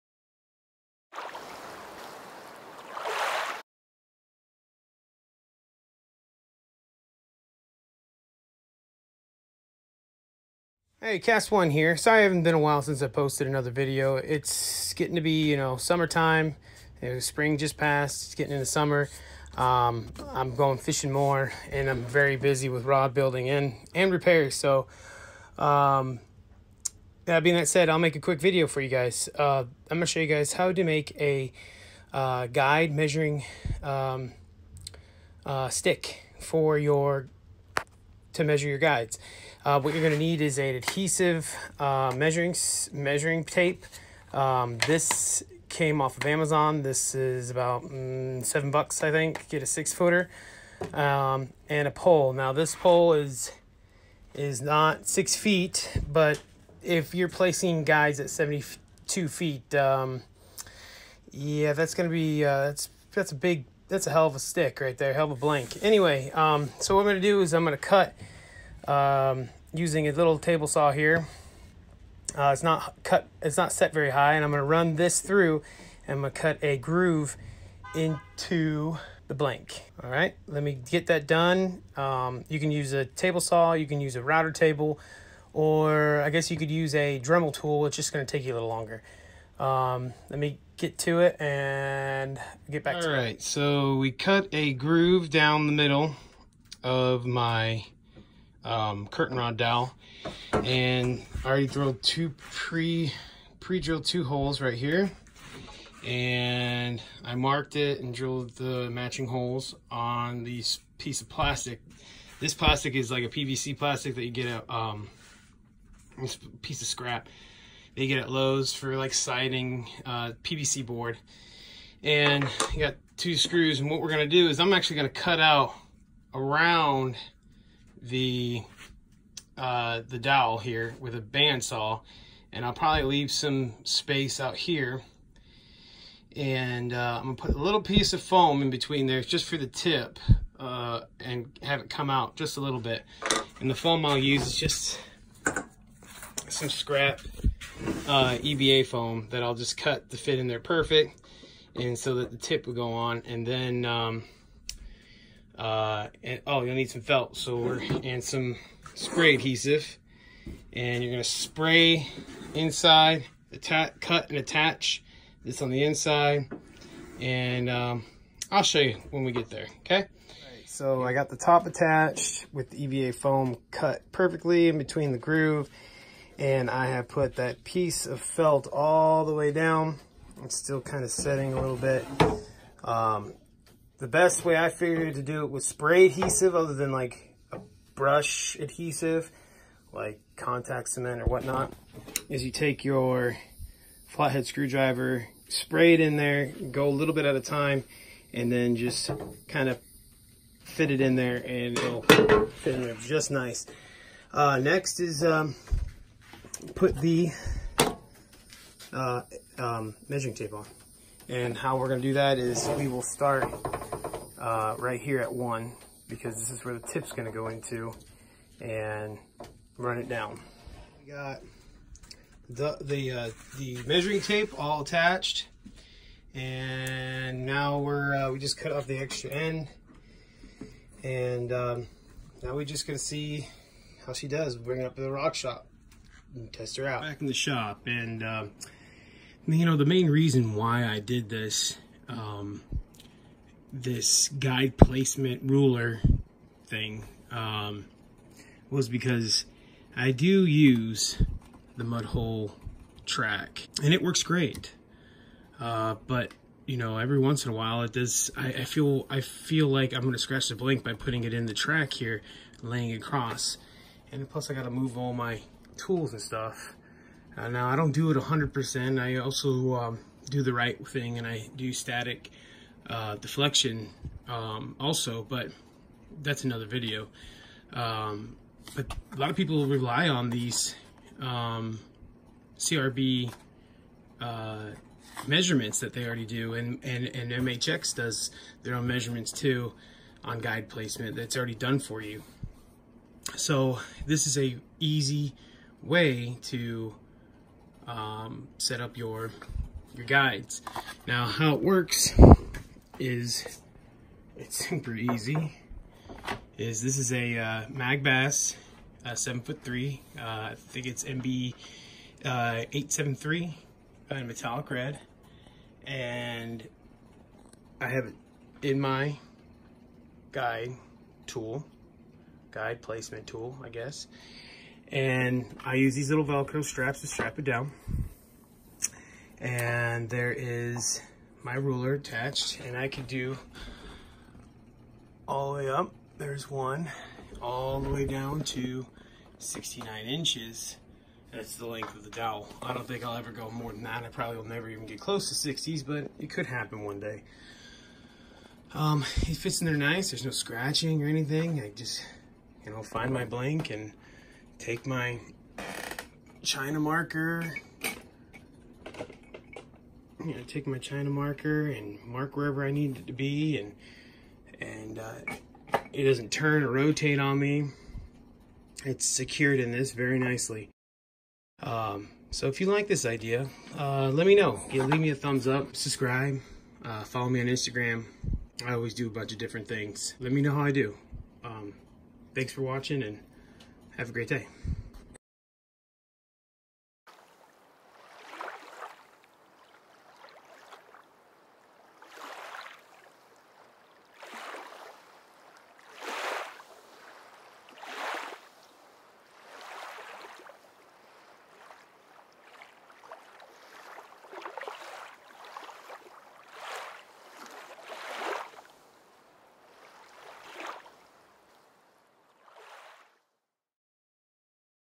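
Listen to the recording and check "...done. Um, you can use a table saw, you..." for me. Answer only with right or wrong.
right.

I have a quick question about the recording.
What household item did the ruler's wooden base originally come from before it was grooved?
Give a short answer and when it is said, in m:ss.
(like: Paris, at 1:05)
curtain rod dowel, at 1:39.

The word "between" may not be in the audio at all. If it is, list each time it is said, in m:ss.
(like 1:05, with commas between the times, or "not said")
2:18, 2:54.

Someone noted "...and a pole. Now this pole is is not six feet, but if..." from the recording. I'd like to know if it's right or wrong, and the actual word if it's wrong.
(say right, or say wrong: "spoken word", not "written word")
right.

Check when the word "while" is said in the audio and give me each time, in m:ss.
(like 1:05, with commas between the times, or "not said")
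0:12, 4:17.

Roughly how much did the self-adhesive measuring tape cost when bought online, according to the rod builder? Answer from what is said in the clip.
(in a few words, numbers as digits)
$7.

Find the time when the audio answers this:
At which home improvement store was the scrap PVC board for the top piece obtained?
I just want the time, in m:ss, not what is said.
1:58.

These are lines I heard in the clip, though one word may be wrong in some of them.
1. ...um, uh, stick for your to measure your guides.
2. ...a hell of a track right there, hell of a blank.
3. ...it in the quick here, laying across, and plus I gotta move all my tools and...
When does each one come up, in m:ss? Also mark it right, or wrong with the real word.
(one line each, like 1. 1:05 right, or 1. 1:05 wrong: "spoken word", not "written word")
1. 0:33 right
2. 1:04 wrong: "stick", not "track"
3. 4:21 wrong: "track", not "quick".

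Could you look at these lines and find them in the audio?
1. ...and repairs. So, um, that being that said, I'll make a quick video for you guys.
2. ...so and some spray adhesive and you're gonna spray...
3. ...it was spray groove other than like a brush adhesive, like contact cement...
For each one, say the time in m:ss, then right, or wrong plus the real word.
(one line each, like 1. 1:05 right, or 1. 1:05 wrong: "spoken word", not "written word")
1. 0:23 right
2. 2:37 right
3. 3:05 wrong: "adhesive", not "groove".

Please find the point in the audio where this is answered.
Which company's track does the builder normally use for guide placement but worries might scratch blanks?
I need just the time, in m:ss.
4:11.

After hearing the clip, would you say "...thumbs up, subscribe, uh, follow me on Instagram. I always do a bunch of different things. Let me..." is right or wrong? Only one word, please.
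right.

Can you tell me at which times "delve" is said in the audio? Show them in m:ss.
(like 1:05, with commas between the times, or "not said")
not said.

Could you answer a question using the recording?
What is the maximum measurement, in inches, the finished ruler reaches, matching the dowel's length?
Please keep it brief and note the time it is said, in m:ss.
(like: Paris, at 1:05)
69, at 5:39.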